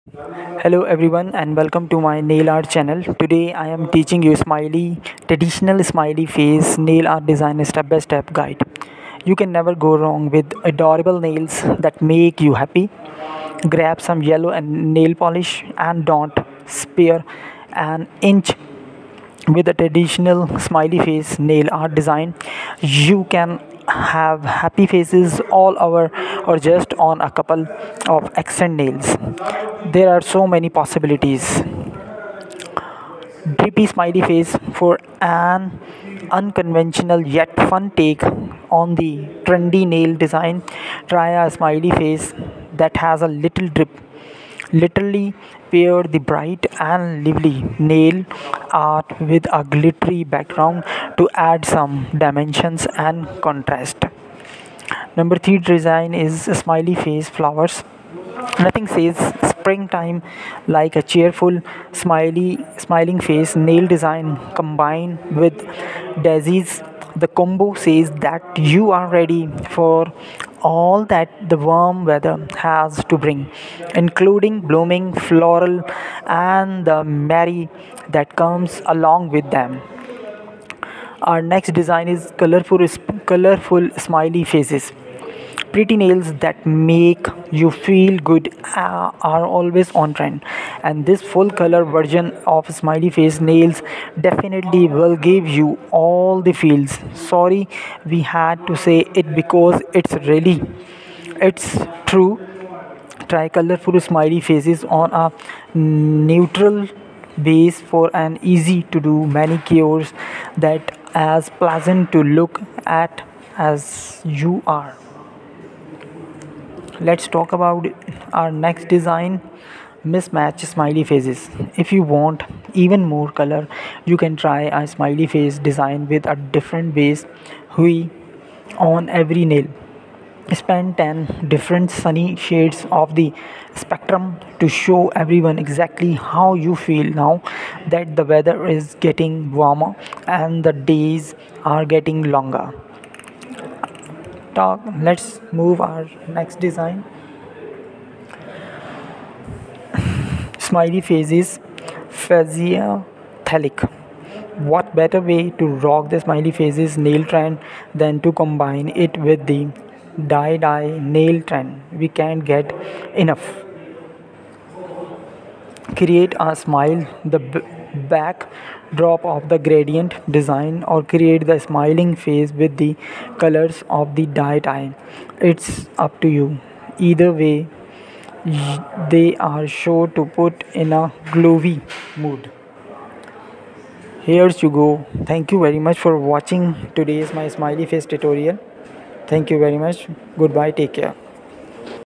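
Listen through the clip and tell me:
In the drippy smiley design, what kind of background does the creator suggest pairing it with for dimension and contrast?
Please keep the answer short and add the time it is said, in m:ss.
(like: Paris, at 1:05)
glittery background, at 0:49.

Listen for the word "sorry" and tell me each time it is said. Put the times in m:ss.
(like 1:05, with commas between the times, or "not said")
1:37.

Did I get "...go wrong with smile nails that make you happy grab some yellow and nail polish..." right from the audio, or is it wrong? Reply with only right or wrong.
wrong.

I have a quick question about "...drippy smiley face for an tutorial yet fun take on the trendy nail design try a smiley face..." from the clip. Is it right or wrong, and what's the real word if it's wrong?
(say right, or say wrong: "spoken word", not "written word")
wrong: "unconventional", not "tutorial".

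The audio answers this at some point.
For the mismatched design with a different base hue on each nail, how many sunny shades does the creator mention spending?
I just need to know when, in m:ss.
2:10.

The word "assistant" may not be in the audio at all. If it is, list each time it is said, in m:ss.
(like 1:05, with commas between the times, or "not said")
not said.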